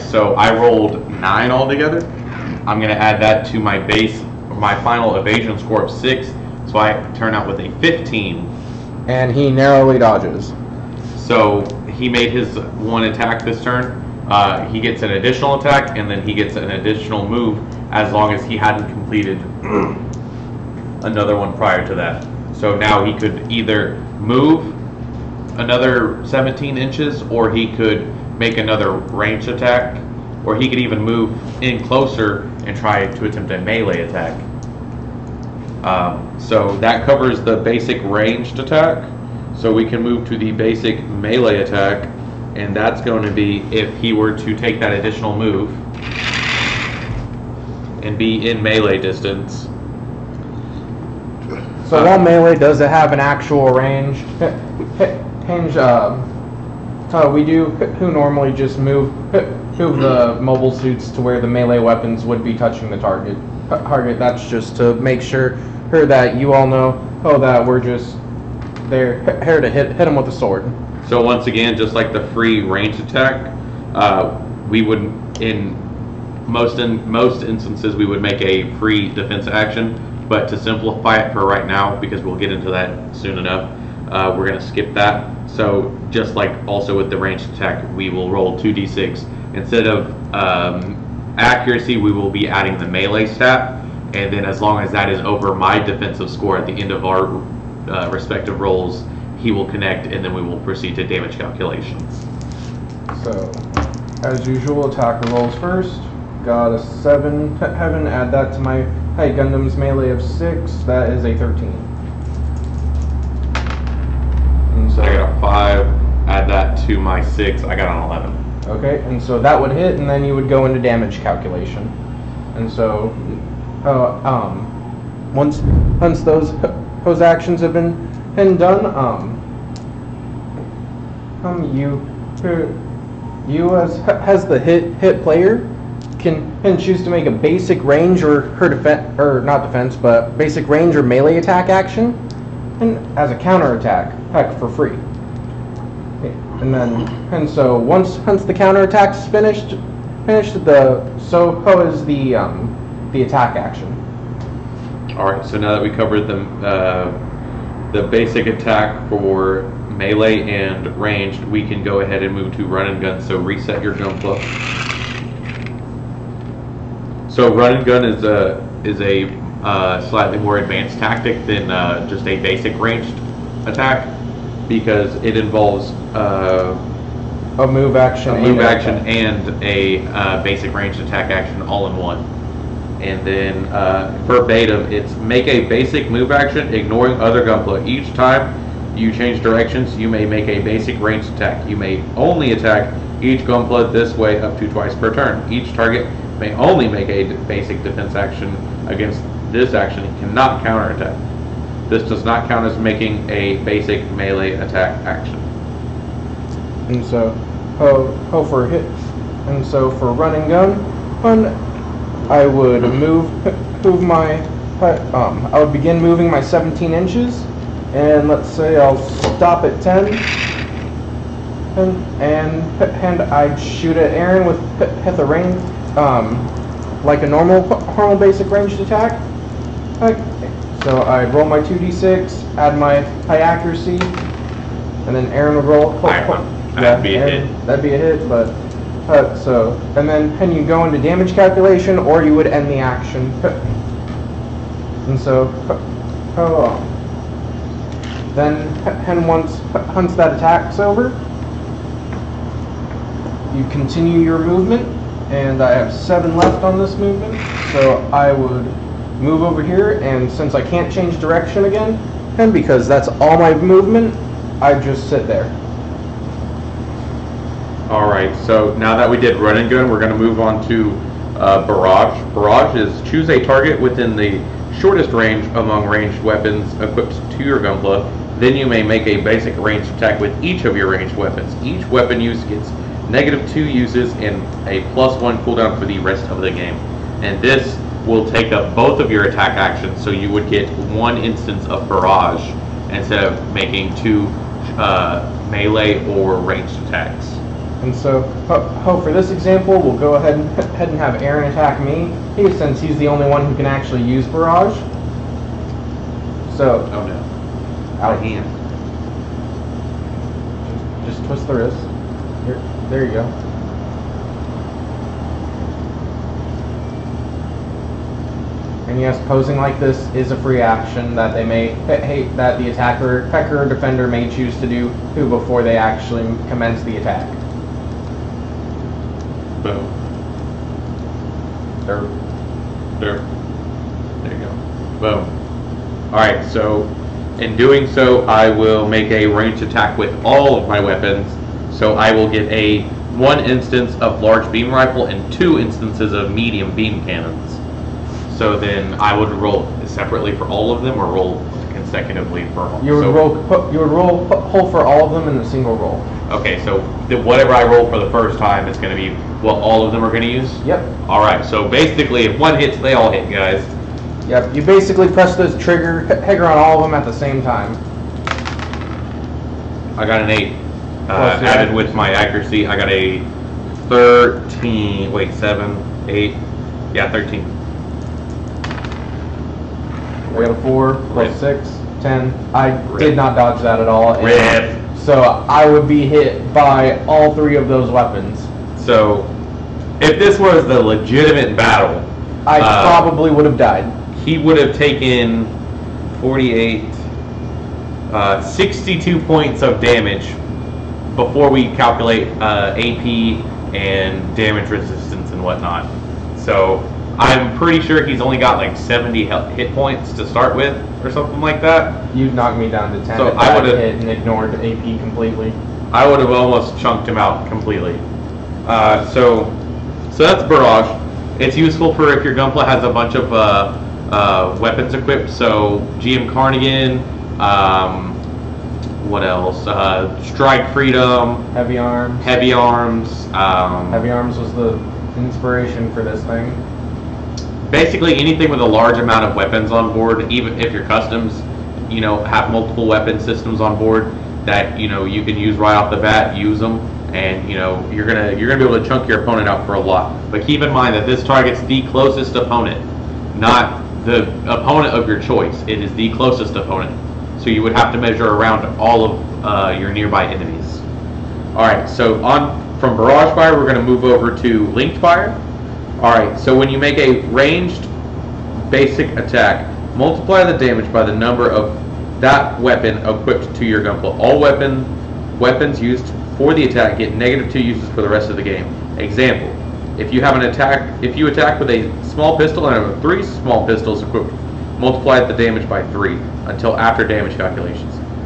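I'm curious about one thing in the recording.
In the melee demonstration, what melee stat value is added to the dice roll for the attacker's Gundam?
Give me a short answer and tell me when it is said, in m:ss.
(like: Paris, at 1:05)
6, at 1:49.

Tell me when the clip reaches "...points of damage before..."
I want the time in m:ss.
6:39.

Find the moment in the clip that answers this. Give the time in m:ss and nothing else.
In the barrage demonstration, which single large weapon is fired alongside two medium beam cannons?
5:44.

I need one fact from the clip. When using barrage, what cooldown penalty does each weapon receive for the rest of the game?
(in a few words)
Plus one.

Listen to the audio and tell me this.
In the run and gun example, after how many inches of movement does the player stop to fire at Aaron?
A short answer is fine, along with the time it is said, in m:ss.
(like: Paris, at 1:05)
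10, at 3:39.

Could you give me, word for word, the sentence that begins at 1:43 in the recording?
So, as usual, attacker rolls first.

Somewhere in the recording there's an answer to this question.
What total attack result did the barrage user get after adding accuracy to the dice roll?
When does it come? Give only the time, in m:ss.
6:12.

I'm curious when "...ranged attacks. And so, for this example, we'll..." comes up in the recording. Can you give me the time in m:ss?
4:56.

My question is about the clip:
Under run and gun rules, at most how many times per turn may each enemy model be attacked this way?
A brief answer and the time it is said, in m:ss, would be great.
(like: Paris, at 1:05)
Twice, at 3:14.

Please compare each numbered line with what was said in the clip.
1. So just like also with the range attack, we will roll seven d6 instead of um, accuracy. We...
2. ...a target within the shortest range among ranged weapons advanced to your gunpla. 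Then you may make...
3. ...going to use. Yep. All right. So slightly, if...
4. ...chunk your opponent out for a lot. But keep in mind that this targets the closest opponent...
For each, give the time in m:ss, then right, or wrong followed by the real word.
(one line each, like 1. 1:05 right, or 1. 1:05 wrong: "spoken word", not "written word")
1. 1:25 wrong: "two", not "seven"
2. 4:33 wrong: "equipped", not "advanced"
3. 6:00 wrong: "basically", not "slightly"
4. 7:28 right.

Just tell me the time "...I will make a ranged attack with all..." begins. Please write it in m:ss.
5:38.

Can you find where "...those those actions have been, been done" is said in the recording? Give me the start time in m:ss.
2:06.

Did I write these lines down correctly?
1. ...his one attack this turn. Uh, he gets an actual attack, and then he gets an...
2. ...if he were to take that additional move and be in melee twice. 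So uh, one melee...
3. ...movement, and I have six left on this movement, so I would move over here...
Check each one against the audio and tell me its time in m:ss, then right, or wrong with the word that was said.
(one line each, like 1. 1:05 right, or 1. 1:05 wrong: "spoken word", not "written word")
1. 0:12 wrong: "additional", not "actual"
2. 0:43 wrong: "distance", not "twice"
3. 4:14 wrong: "seven", not "six".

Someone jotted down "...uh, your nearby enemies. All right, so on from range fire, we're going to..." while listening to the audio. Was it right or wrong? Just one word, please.
wrong.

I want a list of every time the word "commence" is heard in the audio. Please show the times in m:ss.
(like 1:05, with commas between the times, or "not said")
5:26.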